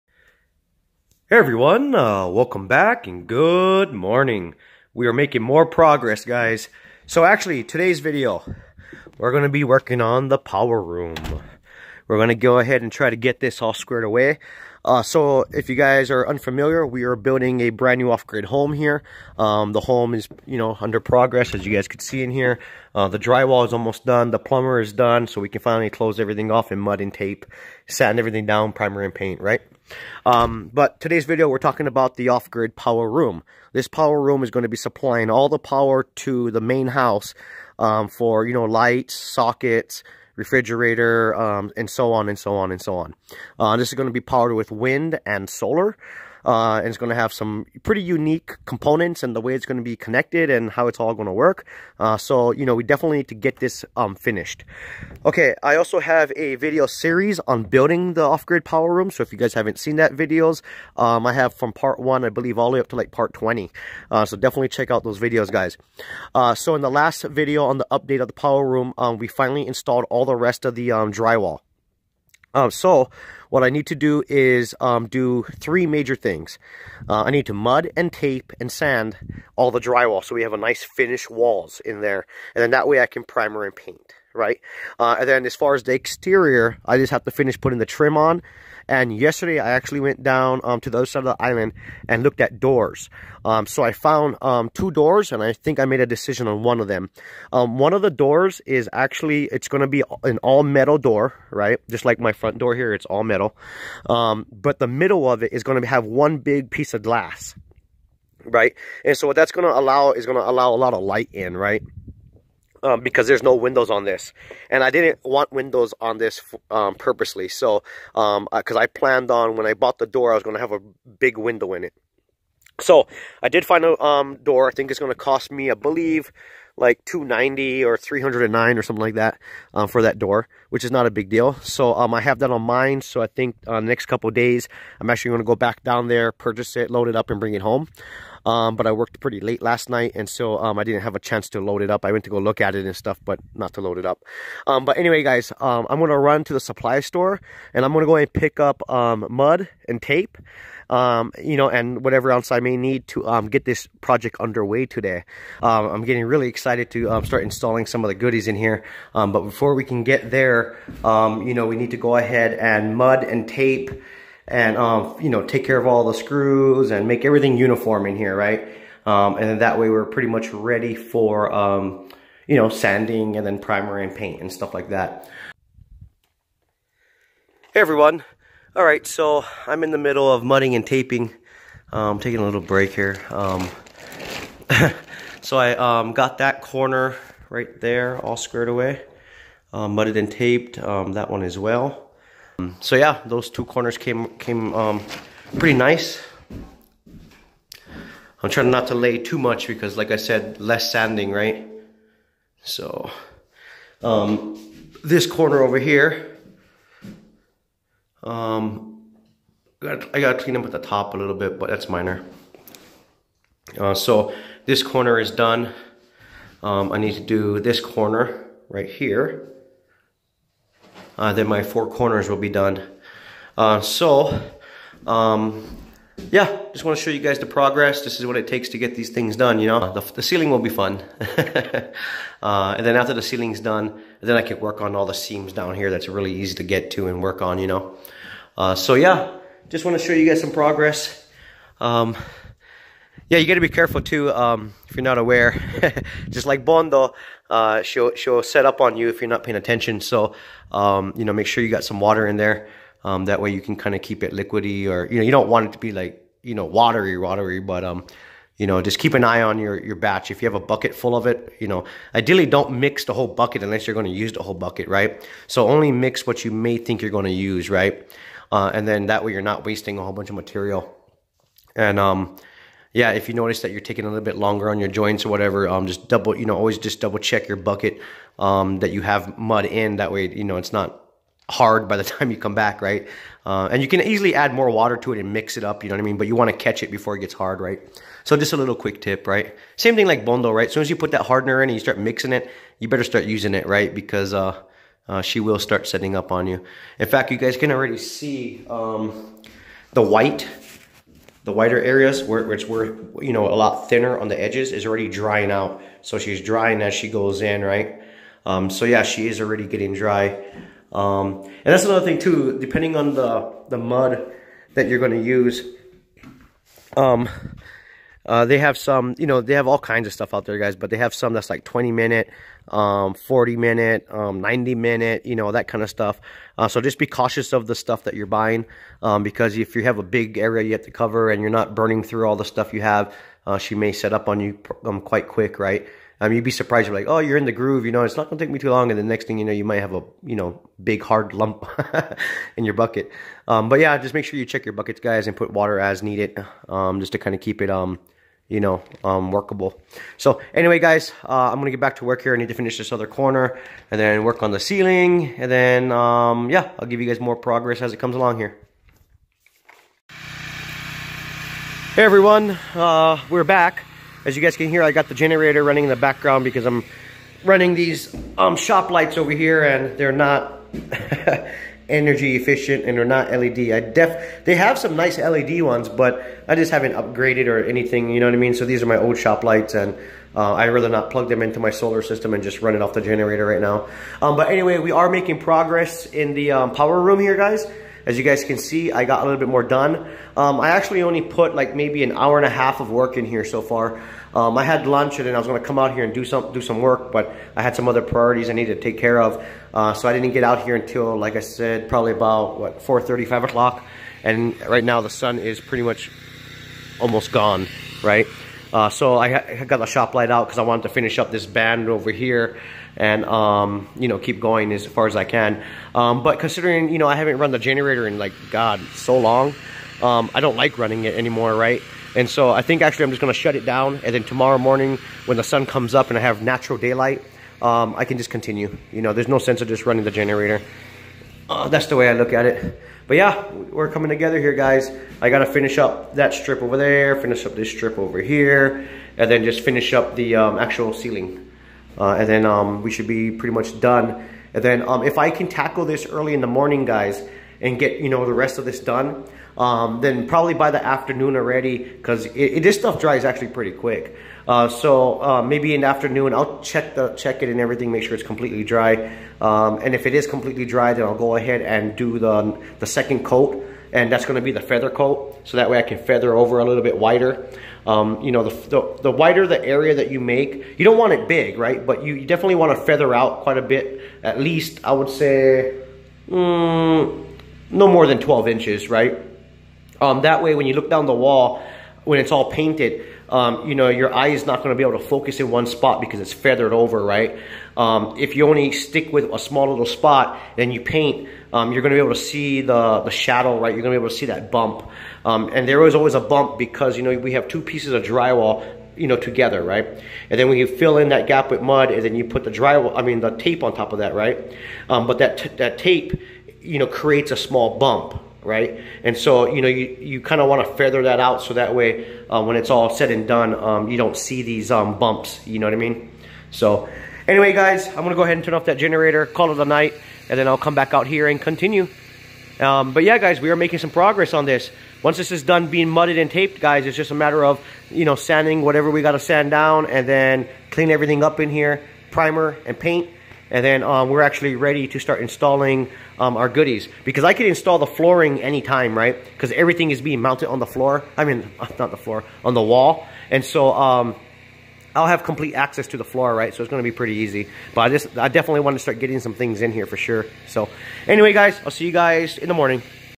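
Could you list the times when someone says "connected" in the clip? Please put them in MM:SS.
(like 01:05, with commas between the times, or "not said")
00:49.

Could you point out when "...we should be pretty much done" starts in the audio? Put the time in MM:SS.
07:22.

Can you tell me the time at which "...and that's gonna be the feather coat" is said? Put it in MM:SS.
07:43.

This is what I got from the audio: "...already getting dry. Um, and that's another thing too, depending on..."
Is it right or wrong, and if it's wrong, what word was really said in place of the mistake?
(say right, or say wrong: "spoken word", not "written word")
right.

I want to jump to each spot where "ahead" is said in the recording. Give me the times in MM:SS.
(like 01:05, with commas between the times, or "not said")
00:12, 02:42, 07:41, 08:38.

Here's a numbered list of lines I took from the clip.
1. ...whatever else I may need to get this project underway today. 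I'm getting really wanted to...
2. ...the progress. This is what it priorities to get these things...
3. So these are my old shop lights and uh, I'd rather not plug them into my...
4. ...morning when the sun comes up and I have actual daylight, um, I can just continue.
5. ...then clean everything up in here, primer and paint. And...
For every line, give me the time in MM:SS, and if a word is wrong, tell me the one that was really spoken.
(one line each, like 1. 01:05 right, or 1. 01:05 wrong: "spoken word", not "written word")
1. 02:32 wrong: "excited", not "wanted"
2. 03:47 wrong: "takes", not "priorities"
3. 06:18 right
4. 07:04 wrong: "natural", not "actual"
5. 08:50 right.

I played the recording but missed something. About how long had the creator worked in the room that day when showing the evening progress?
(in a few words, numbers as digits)
An hour and a half.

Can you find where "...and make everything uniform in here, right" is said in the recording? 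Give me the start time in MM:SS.
02:46.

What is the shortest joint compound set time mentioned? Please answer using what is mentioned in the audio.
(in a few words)
20 minutes.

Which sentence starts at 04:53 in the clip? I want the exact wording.
Because uh, uh, she will start setting up on you.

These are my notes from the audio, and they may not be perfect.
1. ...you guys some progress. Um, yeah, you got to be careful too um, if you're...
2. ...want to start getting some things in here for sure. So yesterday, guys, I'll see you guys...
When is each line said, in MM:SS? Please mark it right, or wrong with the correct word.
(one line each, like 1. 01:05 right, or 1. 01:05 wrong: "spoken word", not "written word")
1. 04:00 right
2. 09:08 wrong: "anyway", not "yesterday".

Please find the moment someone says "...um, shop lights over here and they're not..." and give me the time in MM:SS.
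06:08.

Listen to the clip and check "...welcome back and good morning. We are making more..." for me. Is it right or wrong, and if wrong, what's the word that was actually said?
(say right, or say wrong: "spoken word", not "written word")
right.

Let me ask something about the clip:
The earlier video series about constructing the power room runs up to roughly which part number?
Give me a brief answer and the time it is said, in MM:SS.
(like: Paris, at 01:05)
Part 20, at 01:03.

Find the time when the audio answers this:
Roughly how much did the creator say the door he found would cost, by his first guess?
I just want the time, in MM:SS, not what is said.
02:07.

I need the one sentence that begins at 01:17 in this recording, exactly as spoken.
Uh, I need to mud and tape and sand all the drywall so we have a nice finished walls in there.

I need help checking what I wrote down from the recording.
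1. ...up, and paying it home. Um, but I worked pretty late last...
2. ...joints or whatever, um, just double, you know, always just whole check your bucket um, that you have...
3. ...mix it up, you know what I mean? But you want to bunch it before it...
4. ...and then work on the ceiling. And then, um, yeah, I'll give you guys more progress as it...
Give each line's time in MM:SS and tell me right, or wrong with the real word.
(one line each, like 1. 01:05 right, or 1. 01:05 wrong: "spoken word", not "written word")
1. 02:17 wrong: "bring", not "paying"
2. 04:34 wrong: "double", not "whole"
3. 04:45 wrong: "catch", not "bunch"
4. 05:53 right.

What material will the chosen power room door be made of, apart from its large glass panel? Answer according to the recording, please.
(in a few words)
Metal.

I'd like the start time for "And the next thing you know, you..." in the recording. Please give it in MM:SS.
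05:38.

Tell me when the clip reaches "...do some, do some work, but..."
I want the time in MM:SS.
06:36.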